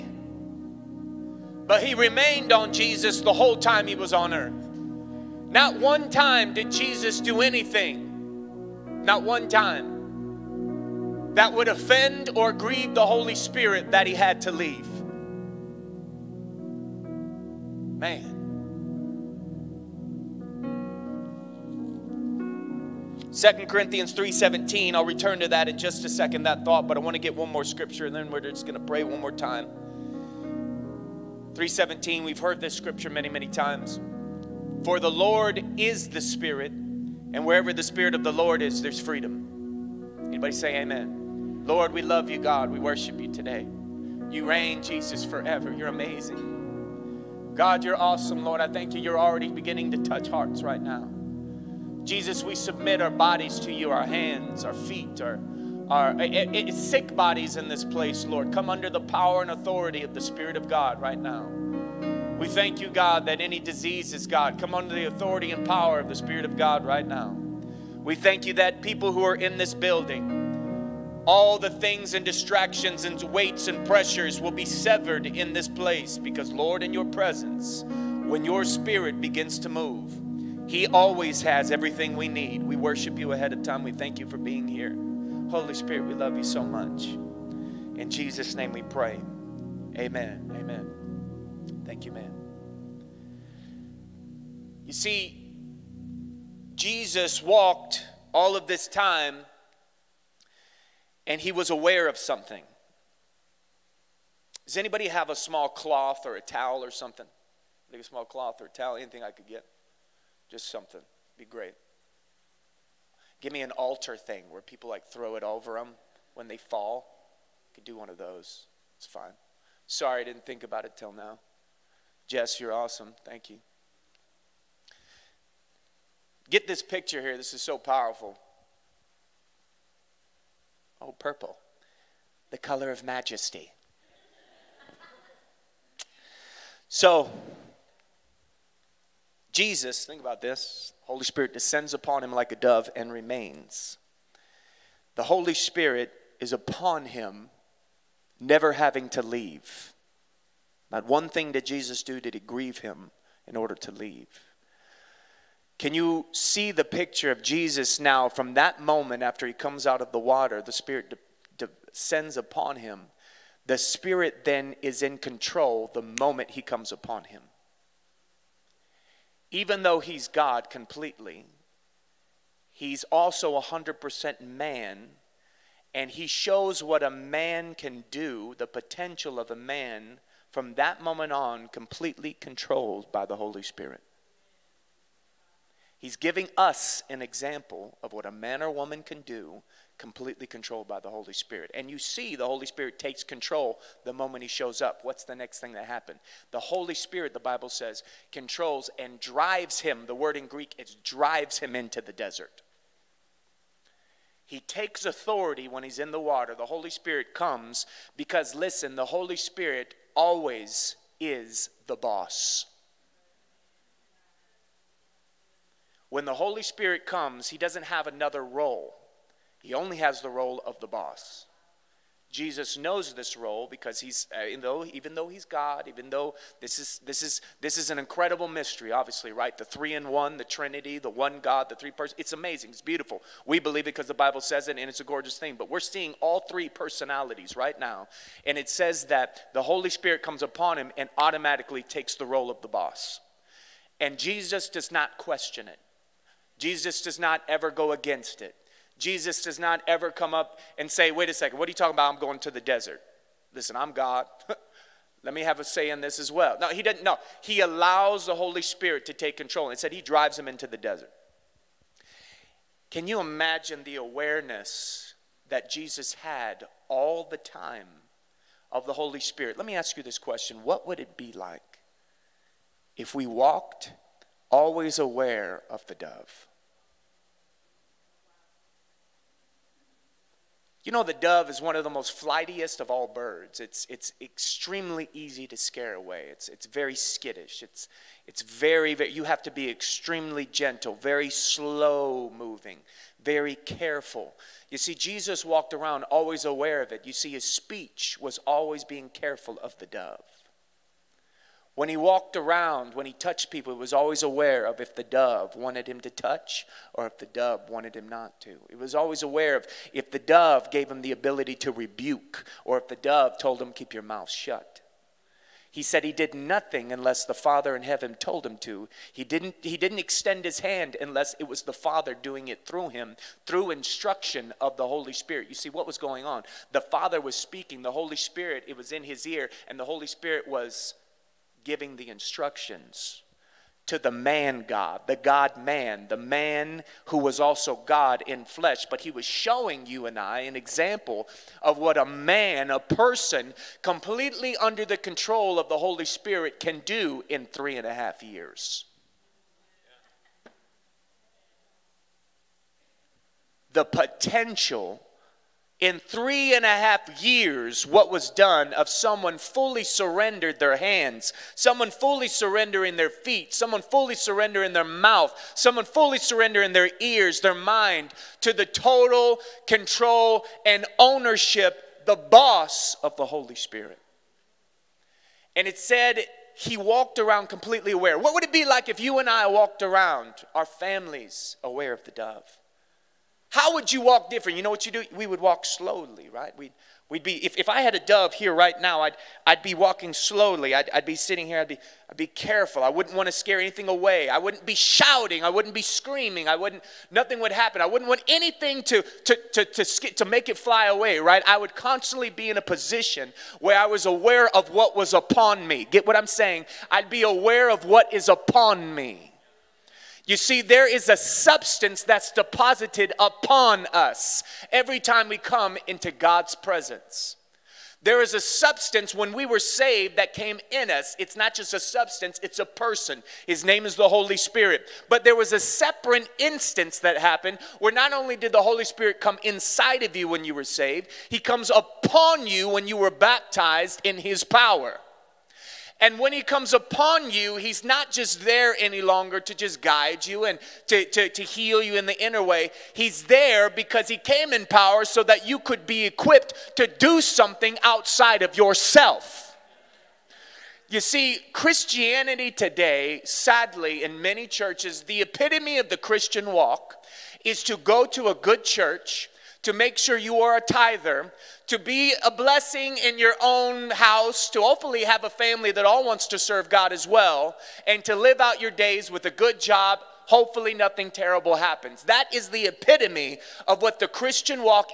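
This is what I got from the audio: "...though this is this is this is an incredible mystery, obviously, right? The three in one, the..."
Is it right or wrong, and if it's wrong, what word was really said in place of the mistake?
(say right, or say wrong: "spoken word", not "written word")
right.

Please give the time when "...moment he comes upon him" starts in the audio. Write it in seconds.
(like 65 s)
166 s.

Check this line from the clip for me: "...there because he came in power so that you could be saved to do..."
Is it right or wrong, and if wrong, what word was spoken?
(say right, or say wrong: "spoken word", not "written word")
wrong: "equipped", not "saved".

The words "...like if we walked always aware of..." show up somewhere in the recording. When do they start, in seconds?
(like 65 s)
271 s.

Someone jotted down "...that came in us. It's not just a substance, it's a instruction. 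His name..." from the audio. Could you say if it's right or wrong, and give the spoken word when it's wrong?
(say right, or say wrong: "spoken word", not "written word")
wrong: "person", not "instruction".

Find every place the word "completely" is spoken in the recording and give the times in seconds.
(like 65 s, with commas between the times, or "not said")
170 s, 181 s, 189 s, 343 s, 377 s.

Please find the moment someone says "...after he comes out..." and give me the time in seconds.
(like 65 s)
159 s.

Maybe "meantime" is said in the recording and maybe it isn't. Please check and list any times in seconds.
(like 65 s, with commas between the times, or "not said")
not said.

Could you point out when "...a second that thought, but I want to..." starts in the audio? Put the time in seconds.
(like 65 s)
26 s.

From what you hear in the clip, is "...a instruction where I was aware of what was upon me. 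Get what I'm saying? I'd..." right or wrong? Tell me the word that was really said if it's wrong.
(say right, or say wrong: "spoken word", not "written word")
wrong: "position", not "instruction".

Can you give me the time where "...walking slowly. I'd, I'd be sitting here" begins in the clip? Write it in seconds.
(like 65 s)
389 s.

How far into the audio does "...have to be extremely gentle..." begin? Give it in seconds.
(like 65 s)
289 s.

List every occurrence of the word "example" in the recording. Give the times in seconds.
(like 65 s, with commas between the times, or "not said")
187 s, 340 s.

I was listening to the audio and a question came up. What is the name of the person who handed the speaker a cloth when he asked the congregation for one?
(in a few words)
Jess.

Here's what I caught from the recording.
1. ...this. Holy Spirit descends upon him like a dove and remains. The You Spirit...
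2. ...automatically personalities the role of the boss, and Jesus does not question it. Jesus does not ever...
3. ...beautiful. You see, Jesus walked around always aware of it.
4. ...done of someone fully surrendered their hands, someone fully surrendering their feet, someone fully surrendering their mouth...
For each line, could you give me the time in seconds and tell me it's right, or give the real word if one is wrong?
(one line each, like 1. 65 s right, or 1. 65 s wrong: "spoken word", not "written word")
1. 140 s wrong: "Holy", not "You"
2. 241 s wrong: "takes", not "personalities"
3. 293 s wrong: "careful", not "beautiful"
4. 358 s right.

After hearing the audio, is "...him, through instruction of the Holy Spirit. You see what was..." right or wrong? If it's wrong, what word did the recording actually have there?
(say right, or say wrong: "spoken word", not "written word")
right.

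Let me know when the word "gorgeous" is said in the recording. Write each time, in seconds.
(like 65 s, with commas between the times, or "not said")
235 s.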